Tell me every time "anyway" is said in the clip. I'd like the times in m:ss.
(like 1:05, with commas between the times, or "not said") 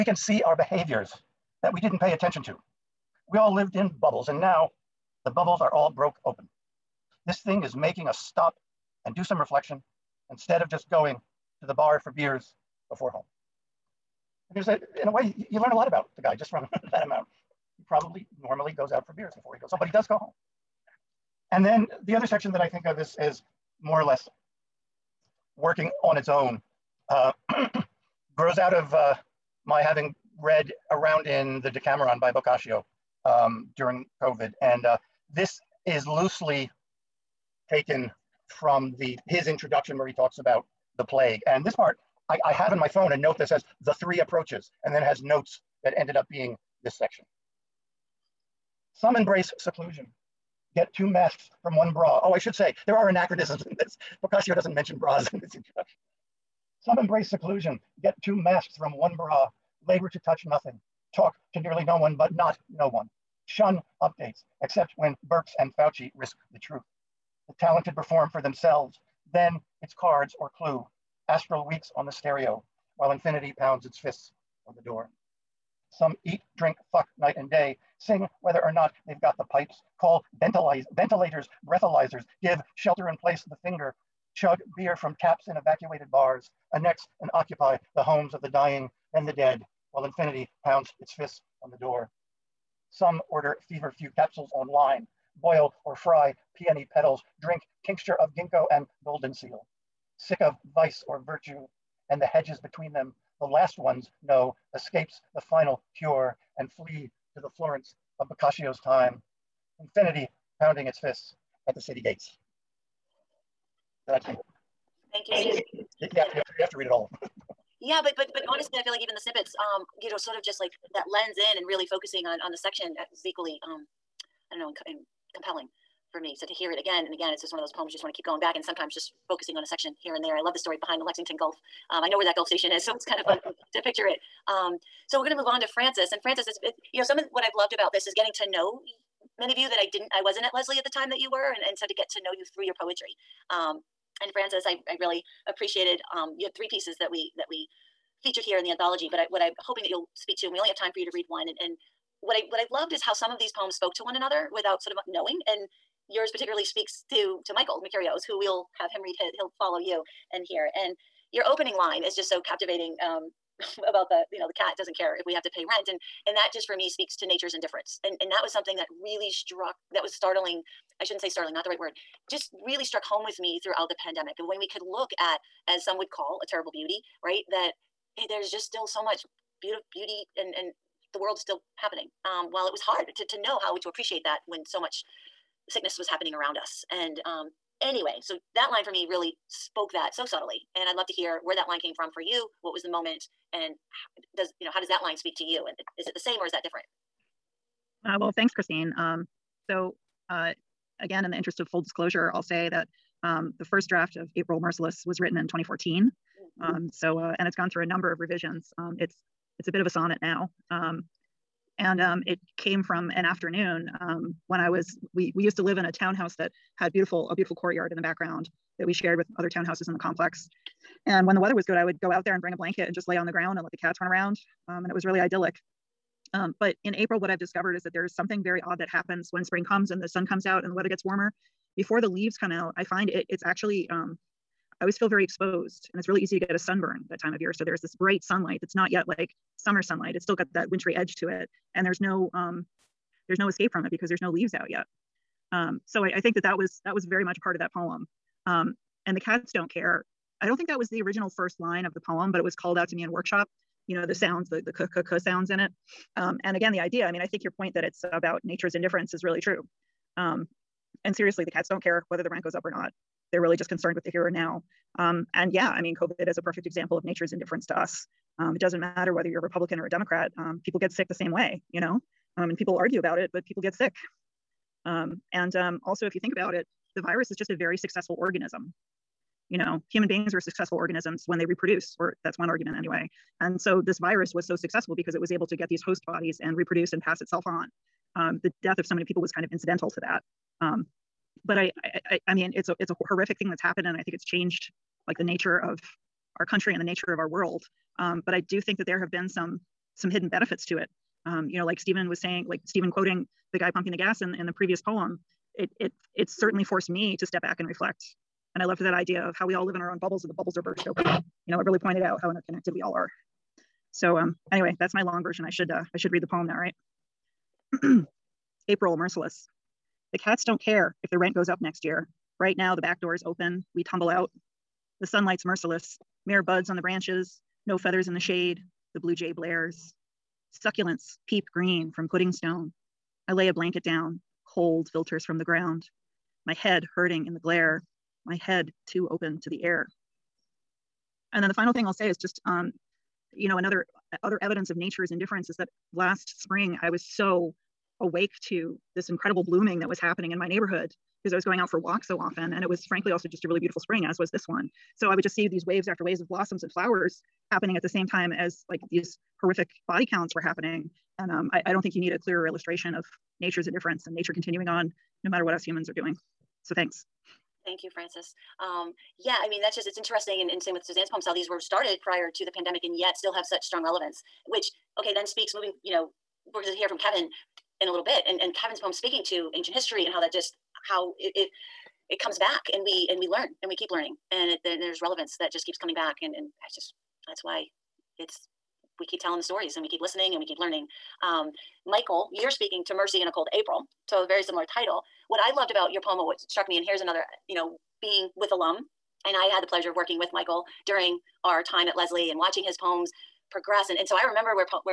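3:07, 4:42, 5:14.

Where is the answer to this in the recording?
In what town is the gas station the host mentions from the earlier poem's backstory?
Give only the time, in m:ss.
2:11.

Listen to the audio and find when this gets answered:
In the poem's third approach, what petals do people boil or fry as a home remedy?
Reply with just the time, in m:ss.
1:36.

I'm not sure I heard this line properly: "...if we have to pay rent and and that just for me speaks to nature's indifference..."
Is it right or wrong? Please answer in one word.
right.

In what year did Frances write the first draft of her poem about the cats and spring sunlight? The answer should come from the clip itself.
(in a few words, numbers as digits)
2014.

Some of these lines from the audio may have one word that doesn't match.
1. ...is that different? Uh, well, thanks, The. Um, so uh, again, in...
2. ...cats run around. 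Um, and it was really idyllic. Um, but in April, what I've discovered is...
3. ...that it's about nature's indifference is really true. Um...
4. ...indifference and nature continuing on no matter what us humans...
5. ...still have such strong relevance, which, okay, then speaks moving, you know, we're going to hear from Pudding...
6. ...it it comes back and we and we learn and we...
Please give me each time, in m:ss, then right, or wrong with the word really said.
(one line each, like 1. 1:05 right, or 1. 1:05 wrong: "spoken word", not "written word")
1. 3:16 wrong: "Christine", not "The"
2. 3:43 right
3. 4:17 right
4. 6:03 right
5. 6:13 wrong: "Kevin", not "Pudding"
6. 6:21 right.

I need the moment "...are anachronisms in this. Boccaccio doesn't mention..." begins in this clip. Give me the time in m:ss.
0:52.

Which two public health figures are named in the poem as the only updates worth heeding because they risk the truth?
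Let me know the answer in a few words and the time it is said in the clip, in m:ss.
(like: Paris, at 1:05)
Birx and Fauci, at 1:05.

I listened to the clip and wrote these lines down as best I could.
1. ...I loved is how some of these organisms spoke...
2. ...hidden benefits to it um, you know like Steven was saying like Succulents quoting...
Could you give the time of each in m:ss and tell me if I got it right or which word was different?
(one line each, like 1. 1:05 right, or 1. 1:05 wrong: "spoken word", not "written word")
1. 2:32 wrong: "poems", not "organisms"
2. 5:00 wrong: "Steven", not "Succulents".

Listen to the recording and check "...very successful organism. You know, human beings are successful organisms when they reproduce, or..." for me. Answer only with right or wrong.
right.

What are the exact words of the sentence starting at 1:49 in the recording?
Infinity pounding its fists, at the city gates.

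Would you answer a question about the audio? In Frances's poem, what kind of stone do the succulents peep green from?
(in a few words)
Pudding stone.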